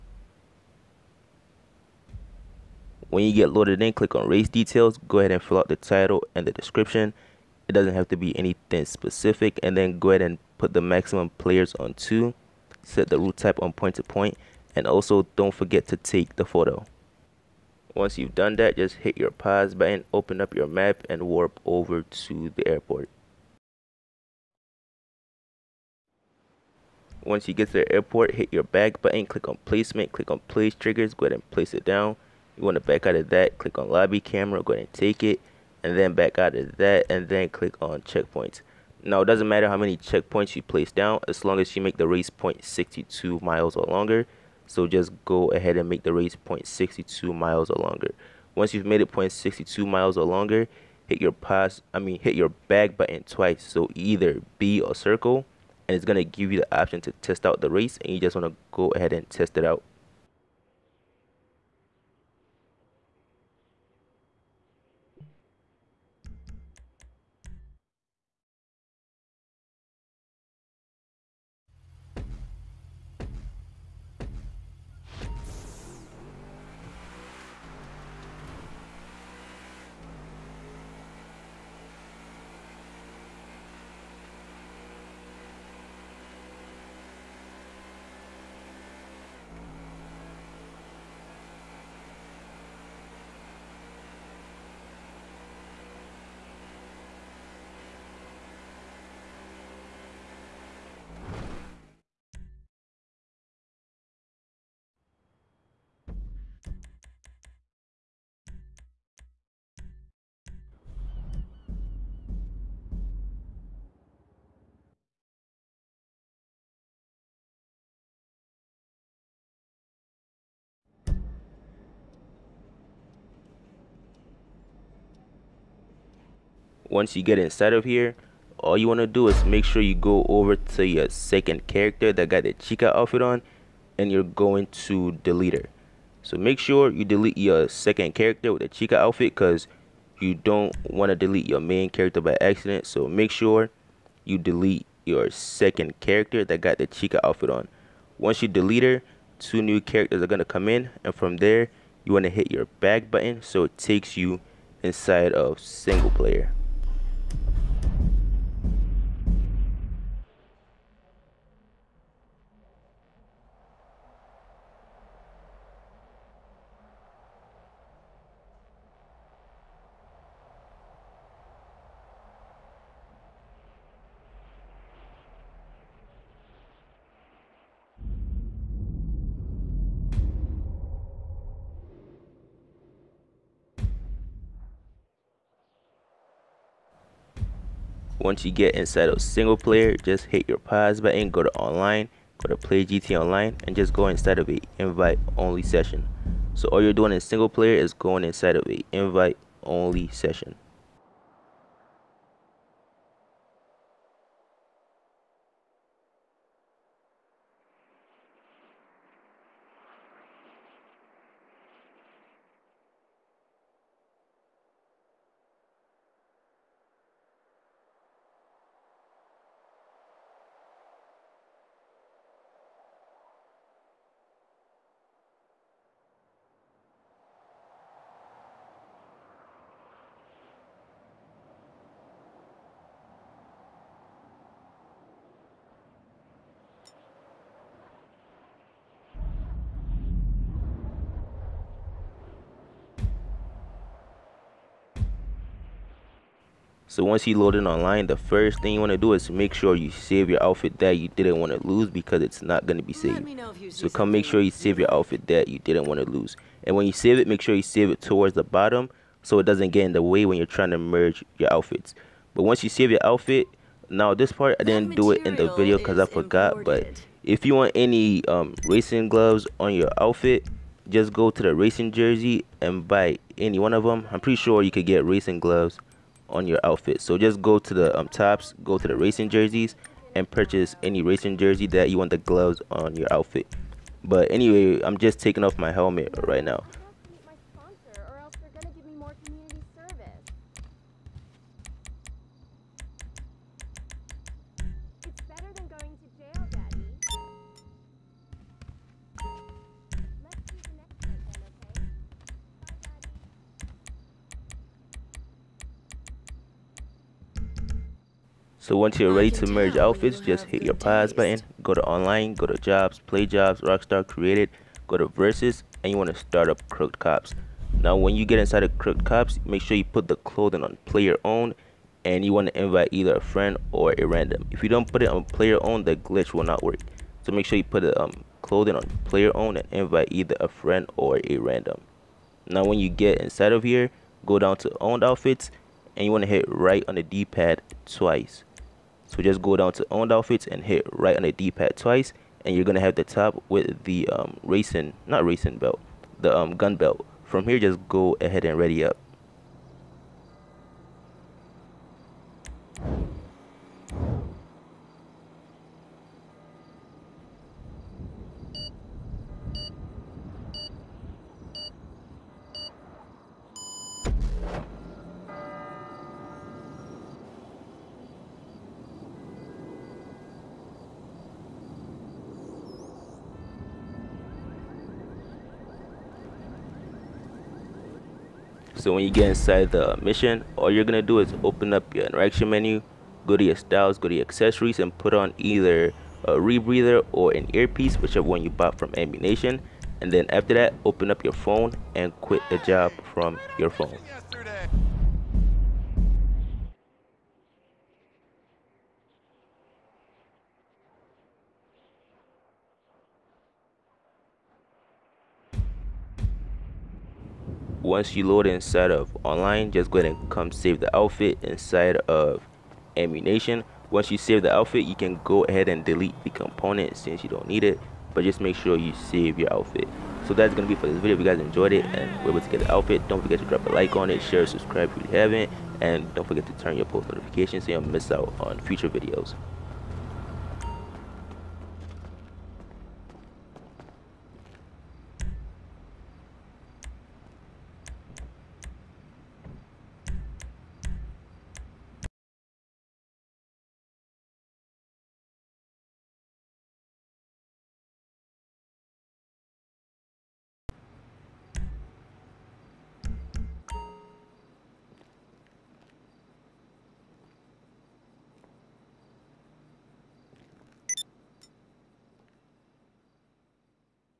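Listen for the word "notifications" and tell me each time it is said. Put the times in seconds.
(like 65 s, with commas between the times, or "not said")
427 s.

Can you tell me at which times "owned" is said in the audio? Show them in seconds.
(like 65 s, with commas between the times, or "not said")
334 s, 339 s.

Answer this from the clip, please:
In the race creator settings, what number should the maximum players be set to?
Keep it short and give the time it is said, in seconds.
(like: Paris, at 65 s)
2, at 11 s.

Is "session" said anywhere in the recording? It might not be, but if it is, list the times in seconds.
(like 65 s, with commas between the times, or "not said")
195 s, 200 s.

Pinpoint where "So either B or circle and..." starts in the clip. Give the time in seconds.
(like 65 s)
53 s.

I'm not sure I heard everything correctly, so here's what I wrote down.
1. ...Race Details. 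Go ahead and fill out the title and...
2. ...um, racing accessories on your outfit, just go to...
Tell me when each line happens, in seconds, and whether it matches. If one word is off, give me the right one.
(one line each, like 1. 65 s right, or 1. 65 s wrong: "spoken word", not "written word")
1. 4 s right
2. 268 s wrong: "gloves", not "accessories".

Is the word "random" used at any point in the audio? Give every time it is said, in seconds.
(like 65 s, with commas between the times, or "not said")
324 s, 331 s.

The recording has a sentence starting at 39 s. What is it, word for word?
Now, it doesn't matter how many checkpoints you place down as long as you make the race 0.62 miles or longer.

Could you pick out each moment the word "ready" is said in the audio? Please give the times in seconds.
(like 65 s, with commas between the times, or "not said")
309 s, 348 s.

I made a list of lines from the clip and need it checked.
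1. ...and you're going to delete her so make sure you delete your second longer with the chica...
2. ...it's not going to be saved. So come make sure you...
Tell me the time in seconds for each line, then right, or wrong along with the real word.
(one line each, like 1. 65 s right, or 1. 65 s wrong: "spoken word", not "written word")
1. 133 s wrong: "character", not "longer"
2. 252 s right.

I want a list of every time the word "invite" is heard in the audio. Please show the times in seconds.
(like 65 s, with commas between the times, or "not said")
194 s, 198 s, 322 s, 329 s.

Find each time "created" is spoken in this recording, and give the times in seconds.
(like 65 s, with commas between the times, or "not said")
314 s.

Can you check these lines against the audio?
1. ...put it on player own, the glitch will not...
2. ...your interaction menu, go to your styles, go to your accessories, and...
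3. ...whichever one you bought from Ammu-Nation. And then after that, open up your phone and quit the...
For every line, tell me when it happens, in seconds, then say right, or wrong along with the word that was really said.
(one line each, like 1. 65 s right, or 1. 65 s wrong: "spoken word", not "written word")
1. 324 s right
2. 381 s right
3. 387 s right.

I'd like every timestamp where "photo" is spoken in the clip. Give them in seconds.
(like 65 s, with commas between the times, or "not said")
16 s.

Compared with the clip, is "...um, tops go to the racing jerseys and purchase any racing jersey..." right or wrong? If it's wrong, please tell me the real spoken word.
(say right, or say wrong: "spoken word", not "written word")
right.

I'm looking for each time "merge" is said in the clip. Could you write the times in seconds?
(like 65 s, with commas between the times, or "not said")
260 s, 309 s.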